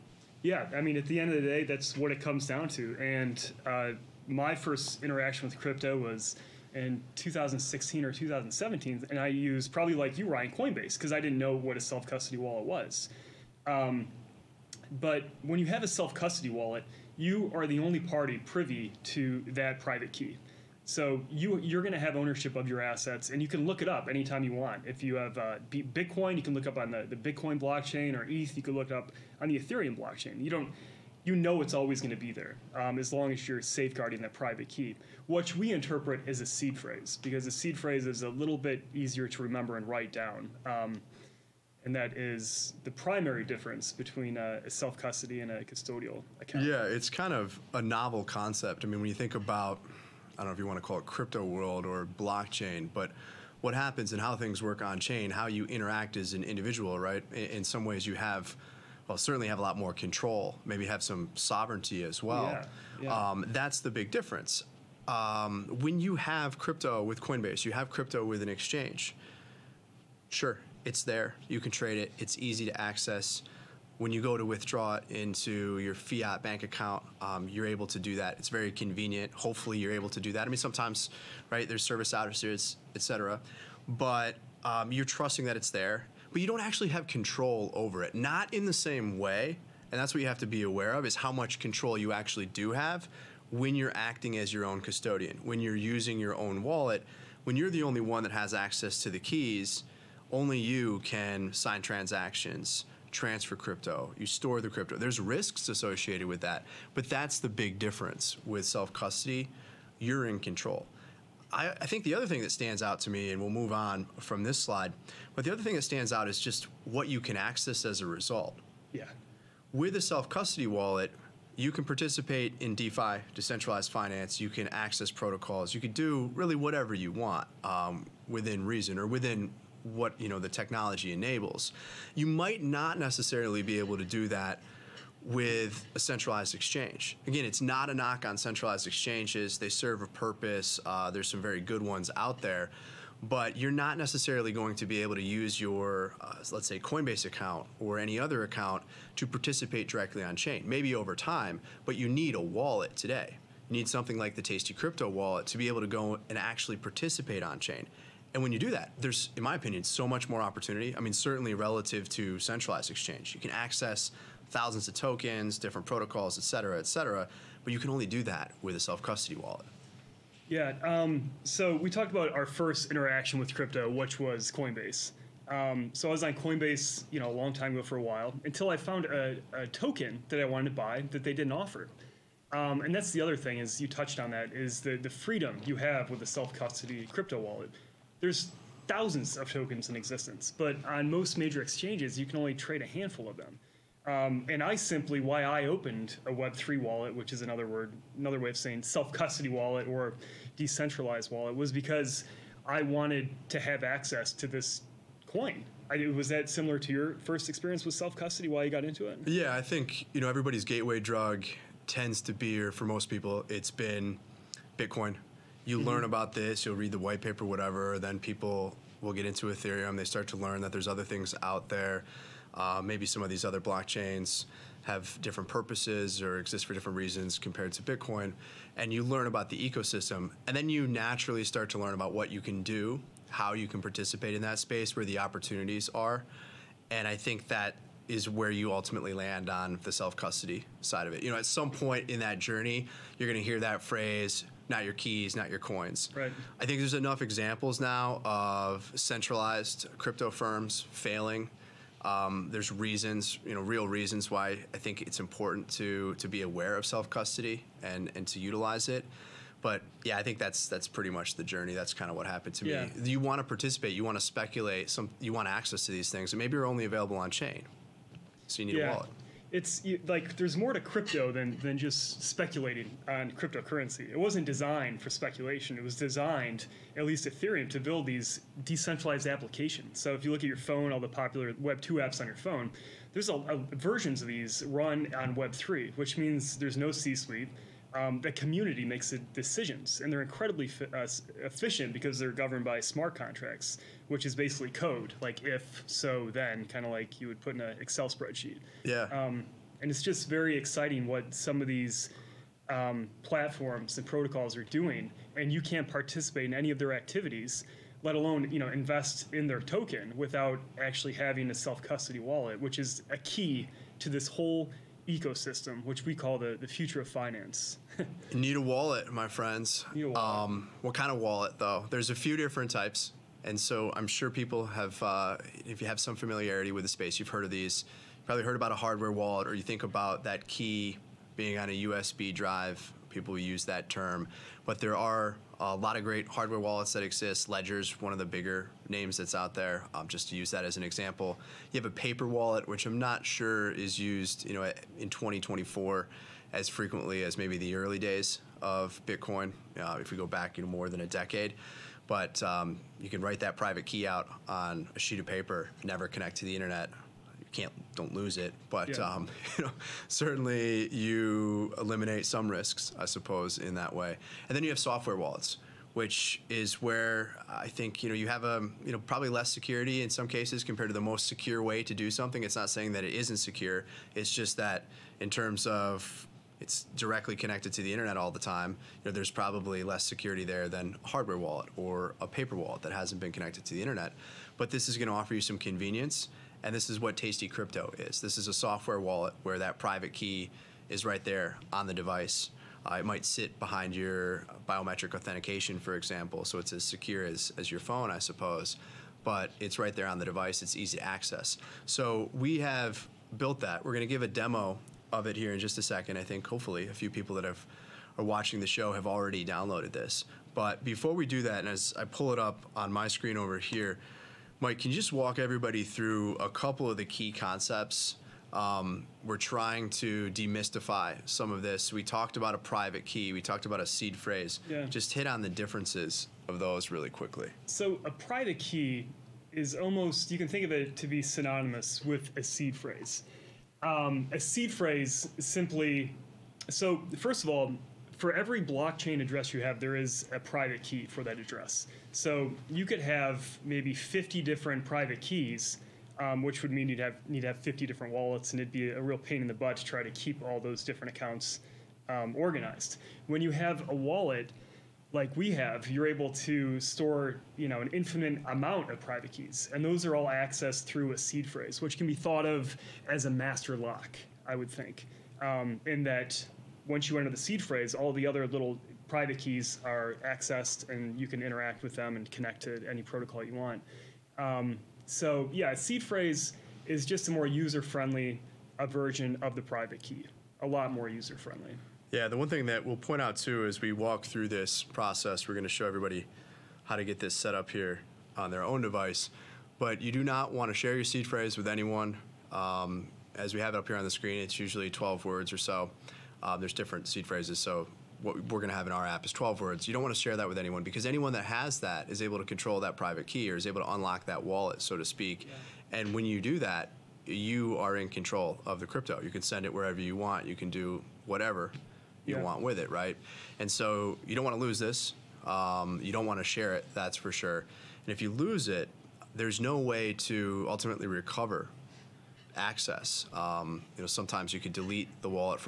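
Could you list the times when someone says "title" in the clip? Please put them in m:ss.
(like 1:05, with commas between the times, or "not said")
not said.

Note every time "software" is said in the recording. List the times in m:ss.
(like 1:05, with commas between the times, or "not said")
6:04, 6:28.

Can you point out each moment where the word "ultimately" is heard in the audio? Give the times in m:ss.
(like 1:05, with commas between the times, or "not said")
3:58, 8:40.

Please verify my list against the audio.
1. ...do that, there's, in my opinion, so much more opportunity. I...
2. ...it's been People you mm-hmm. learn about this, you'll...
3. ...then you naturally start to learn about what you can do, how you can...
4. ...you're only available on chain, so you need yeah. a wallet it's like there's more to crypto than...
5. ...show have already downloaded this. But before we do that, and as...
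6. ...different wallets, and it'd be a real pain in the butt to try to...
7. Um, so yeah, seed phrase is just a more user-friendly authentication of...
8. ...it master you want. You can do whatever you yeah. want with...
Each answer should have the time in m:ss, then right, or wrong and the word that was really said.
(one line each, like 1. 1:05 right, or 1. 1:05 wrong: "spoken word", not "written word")
1. 2:38 right
2. 3:33 wrong: "Bitcoin", not "People"
3. 3:50 right
4. 4:26 right
5. 6:48 right
6. 7:27 right
7. 7:54 wrong: "version", not "authentication"
8. 8:29 wrong: "wherever", not "master".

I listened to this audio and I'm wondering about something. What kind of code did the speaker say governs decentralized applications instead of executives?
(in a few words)
smart contracts.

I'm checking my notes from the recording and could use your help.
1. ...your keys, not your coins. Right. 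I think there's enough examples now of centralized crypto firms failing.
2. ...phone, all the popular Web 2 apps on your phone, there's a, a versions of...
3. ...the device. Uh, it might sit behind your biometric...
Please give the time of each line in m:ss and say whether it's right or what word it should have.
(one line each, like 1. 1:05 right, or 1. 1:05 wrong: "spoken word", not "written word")
1. 4:04 right
2. 4:40 right
3. 6:31 right.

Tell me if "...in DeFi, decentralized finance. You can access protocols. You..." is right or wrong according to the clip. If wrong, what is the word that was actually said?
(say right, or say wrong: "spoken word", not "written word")
right.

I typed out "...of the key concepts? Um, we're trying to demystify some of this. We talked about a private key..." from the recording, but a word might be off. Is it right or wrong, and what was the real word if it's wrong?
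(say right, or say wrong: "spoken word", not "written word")
right.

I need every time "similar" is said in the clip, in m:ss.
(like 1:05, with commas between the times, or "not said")
3:26.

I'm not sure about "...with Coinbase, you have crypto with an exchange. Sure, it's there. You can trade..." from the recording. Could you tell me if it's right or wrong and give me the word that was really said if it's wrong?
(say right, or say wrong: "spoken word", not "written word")
right.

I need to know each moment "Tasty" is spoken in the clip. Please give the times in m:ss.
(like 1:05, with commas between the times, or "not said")
2:34, 6:27.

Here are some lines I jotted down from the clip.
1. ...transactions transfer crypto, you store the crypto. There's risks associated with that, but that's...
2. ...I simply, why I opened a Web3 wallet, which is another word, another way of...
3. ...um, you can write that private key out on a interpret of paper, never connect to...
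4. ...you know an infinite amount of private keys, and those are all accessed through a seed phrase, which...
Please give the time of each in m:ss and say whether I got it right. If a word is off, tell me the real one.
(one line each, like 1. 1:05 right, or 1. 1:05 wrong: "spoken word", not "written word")
1. 1:41 right
2. 3:14 right
3. 5:52 wrong: "sheet", not "interpret"
4. 7:37 right.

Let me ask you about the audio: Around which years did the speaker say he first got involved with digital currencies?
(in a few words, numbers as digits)
2016 or 2017.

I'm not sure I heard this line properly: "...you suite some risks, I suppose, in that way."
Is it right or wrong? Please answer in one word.
wrong.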